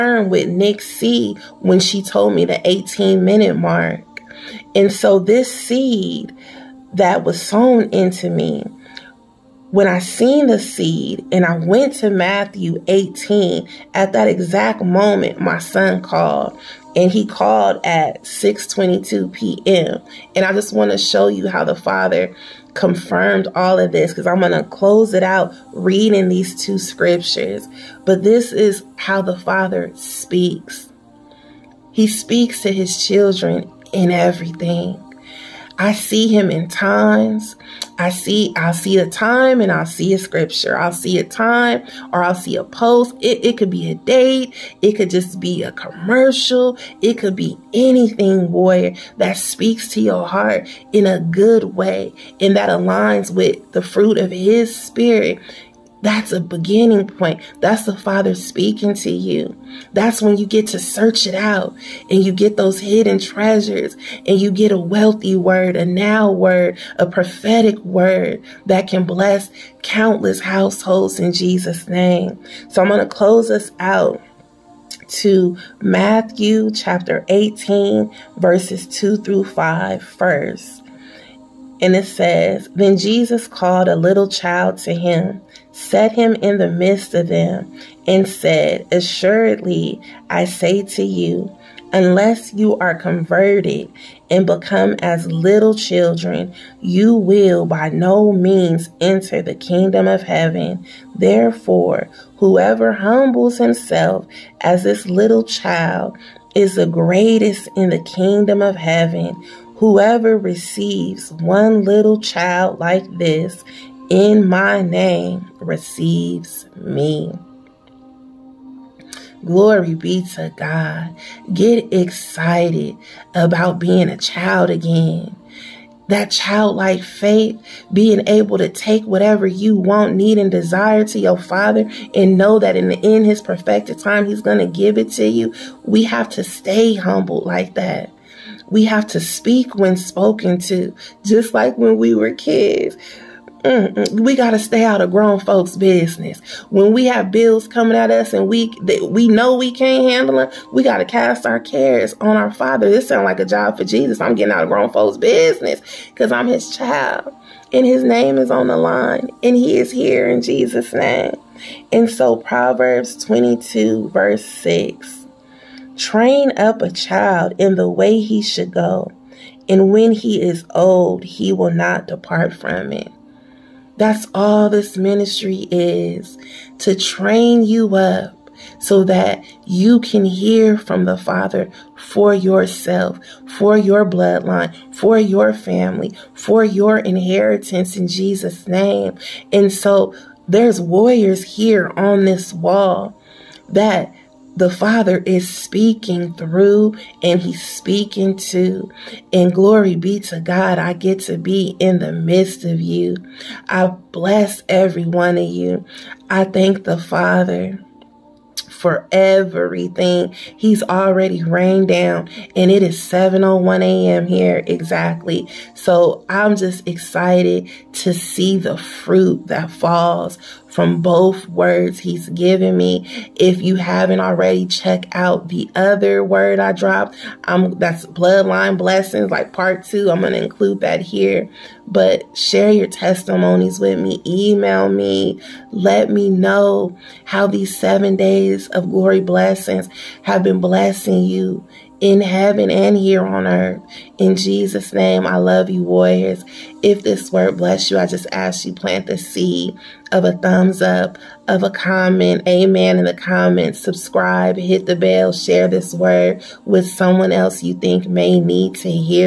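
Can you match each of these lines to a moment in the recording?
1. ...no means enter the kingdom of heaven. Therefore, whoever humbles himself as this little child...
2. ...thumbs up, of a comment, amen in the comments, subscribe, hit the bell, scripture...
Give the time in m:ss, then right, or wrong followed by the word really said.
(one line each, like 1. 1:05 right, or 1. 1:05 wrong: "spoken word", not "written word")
1. 1:37 right
2. 4:10 wrong: "share", not "scripture".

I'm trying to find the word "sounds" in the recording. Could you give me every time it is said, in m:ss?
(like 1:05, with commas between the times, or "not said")
2:33.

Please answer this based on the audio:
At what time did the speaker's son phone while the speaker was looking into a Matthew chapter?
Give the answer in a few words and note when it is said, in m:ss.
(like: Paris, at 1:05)
6:22 p.m., at 0:18.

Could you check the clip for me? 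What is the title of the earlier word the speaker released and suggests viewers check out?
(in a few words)
Bloodline Blessings.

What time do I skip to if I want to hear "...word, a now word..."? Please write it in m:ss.
1:05.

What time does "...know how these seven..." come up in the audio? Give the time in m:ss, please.
3:56.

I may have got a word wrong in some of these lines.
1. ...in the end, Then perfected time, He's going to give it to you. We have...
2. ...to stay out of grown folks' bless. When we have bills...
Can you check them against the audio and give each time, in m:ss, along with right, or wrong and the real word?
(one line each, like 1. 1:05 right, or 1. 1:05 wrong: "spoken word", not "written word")
1. 2:12 wrong: "His", not "Then"
2. 2:24 wrong: "business", not "bless".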